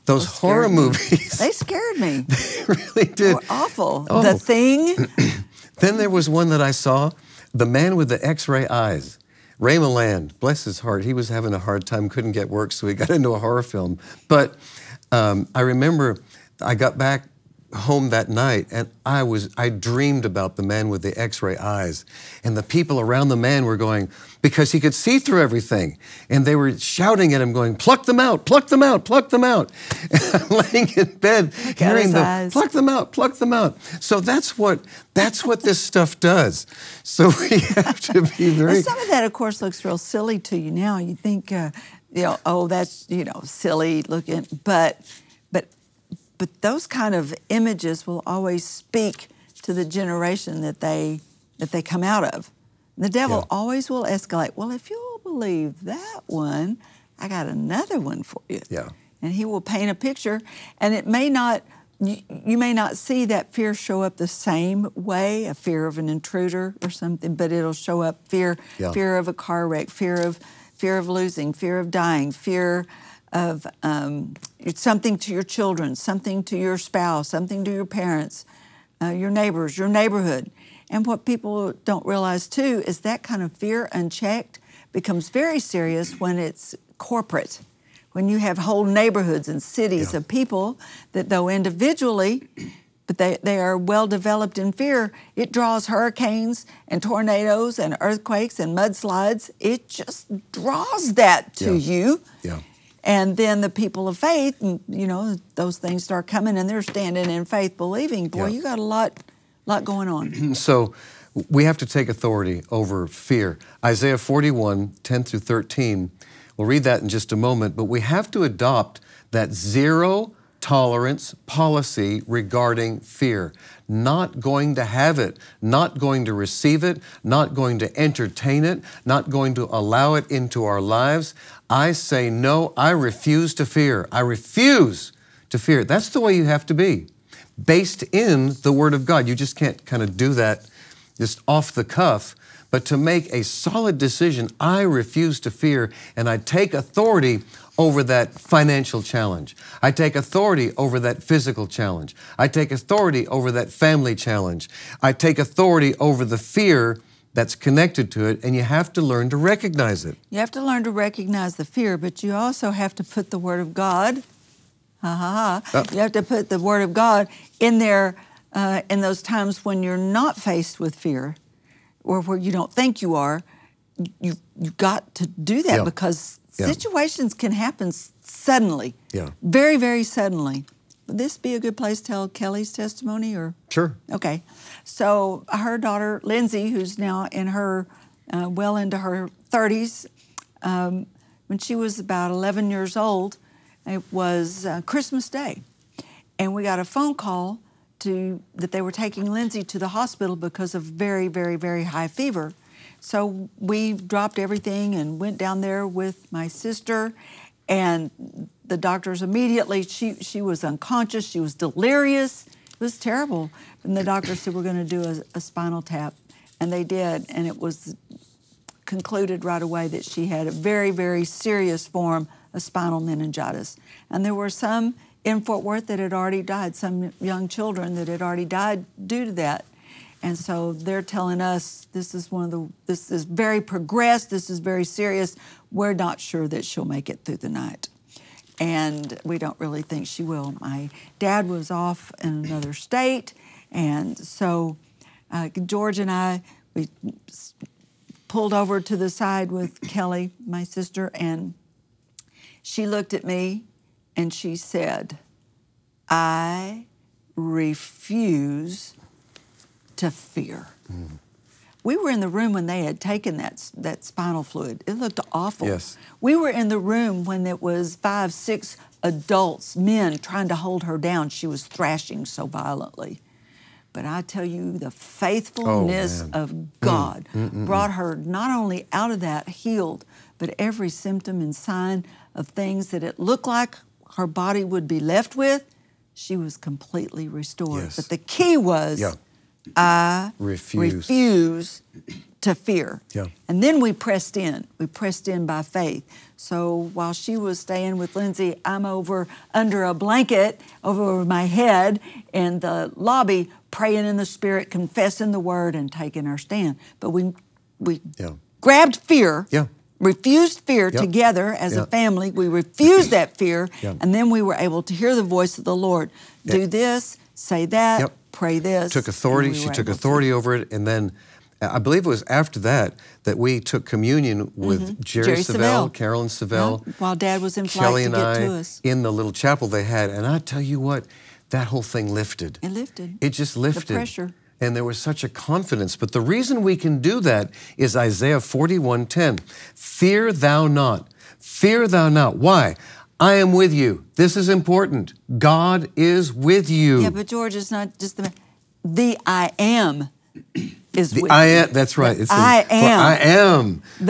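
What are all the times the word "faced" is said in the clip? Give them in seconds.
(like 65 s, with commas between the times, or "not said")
170 s.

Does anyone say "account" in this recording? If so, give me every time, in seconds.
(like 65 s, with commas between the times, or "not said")
not said.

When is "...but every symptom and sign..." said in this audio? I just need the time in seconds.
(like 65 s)
280 s.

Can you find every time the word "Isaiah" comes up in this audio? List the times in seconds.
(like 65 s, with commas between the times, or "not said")
113 s, 337 s.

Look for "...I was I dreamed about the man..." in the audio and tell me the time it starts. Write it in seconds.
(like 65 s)
19 s.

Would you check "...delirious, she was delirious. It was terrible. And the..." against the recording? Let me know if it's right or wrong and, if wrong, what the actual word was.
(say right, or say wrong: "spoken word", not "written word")
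wrong: "unconscious", not "delirious".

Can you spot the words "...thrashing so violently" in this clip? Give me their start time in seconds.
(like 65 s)
271 s.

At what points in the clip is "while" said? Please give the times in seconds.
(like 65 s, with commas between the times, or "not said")
296 s, 326 s.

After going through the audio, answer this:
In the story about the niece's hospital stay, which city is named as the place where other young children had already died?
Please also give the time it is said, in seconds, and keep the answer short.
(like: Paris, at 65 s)
Fort Worth, at 225 s.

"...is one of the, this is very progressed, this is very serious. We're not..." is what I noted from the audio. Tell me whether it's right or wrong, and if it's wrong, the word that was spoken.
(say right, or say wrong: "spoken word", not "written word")
right.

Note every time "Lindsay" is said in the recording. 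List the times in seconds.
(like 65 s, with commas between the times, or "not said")
186 s, 199 s, 298 s.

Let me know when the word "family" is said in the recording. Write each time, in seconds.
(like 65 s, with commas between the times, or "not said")
153 s, 311 s.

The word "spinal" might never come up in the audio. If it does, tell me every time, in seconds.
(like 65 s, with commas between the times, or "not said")
215 s, 222 s, 264 s.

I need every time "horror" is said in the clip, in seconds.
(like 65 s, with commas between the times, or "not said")
0 s, 13 s.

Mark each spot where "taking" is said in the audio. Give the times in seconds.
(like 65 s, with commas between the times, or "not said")
198 s, 305 s.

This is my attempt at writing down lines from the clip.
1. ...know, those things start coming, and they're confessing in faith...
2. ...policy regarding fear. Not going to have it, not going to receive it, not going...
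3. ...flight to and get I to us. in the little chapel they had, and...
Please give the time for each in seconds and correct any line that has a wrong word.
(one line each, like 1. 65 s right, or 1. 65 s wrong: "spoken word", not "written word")
1. 105 s wrong: "standing", not "confessing"
2. 121 s right
3. 327 s right.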